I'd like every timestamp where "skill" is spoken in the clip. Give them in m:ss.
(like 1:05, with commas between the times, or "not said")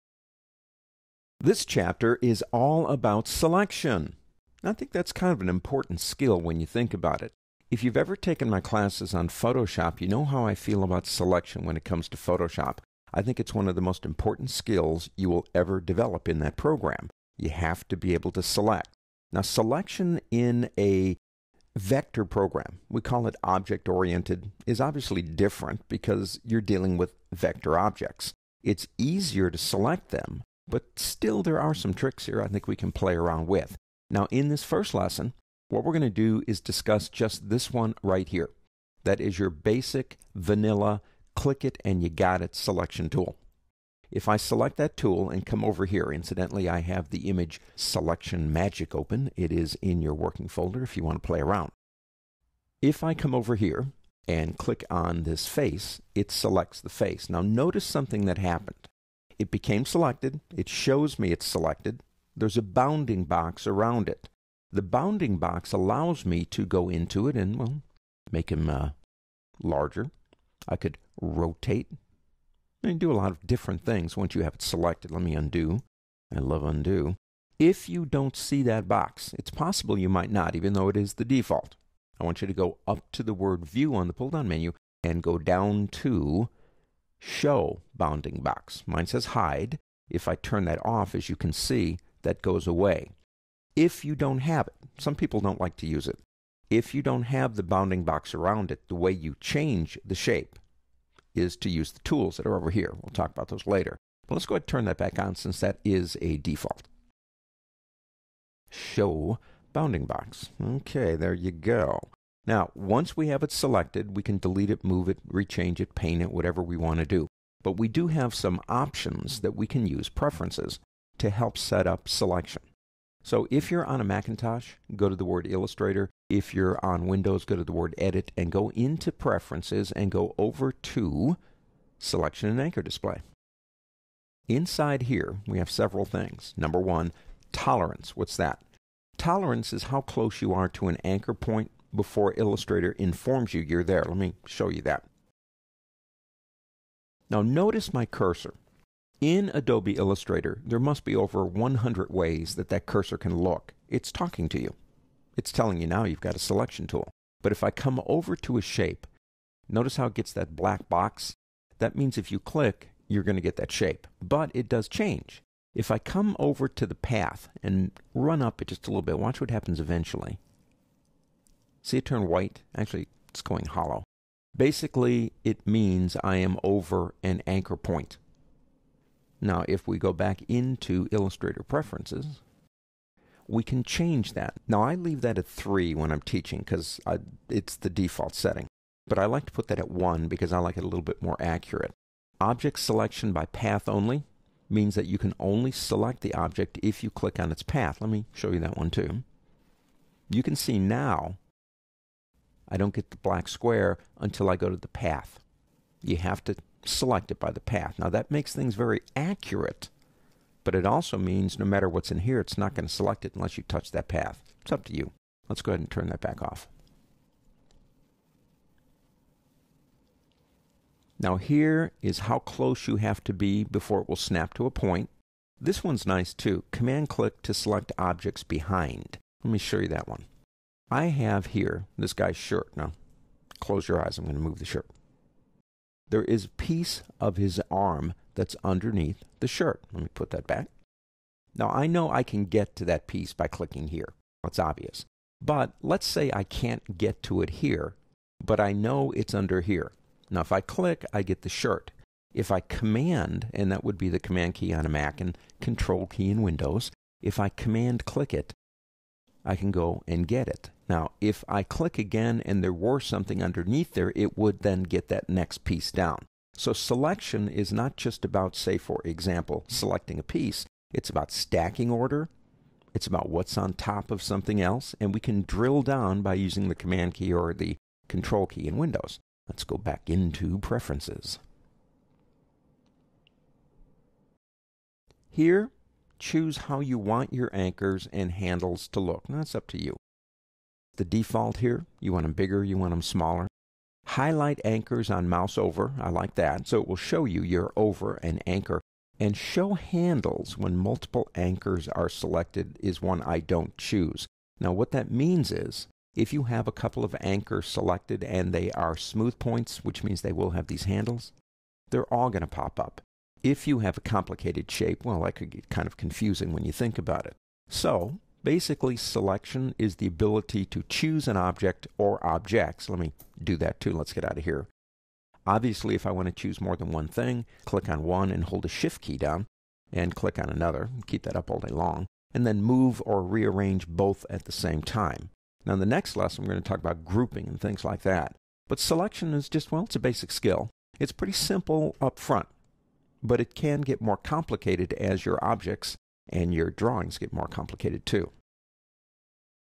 0:05, 0:14, 5:40.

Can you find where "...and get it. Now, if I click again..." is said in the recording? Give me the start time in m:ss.
4:20.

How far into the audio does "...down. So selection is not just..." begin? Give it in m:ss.
4:25.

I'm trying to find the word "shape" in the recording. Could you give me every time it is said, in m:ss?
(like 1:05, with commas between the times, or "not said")
1:40, 2:38, 2:43, 5:14.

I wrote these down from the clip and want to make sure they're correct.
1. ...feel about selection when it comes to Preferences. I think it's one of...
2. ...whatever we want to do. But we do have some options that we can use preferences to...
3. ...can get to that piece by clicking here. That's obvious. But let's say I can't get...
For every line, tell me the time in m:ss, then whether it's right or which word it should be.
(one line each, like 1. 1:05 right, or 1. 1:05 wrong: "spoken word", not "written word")
1. 0:10 wrong: "Photoshop", not "Preferences"
2. 1:56 right
3. 4:02 right.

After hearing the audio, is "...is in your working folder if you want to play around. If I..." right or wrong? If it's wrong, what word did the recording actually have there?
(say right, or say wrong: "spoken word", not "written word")
right.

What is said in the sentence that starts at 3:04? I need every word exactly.
Now, I leave that at 3 when I'm teaching because it's the default setting.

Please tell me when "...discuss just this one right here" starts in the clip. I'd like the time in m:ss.
0:36.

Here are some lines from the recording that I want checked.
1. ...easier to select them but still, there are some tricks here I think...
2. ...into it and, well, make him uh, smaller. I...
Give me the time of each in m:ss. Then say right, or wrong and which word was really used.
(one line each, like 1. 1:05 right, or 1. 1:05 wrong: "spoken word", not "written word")
1. 0:28 right
2. 1:06 wrong: "larger", not "smaller".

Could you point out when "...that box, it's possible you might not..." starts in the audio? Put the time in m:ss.
1:18.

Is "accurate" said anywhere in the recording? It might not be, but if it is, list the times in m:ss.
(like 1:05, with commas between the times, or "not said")
3:11, 3:29.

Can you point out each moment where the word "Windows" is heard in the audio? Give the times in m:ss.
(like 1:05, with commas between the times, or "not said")
2:07, 4:16, 4:38.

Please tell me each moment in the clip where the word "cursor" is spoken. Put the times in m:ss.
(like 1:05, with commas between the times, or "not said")
2:28, 2:32.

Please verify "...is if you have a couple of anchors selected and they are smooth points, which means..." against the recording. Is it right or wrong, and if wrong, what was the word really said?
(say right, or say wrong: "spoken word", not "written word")
right.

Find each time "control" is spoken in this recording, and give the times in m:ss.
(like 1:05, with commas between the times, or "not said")
4:15, 4:38.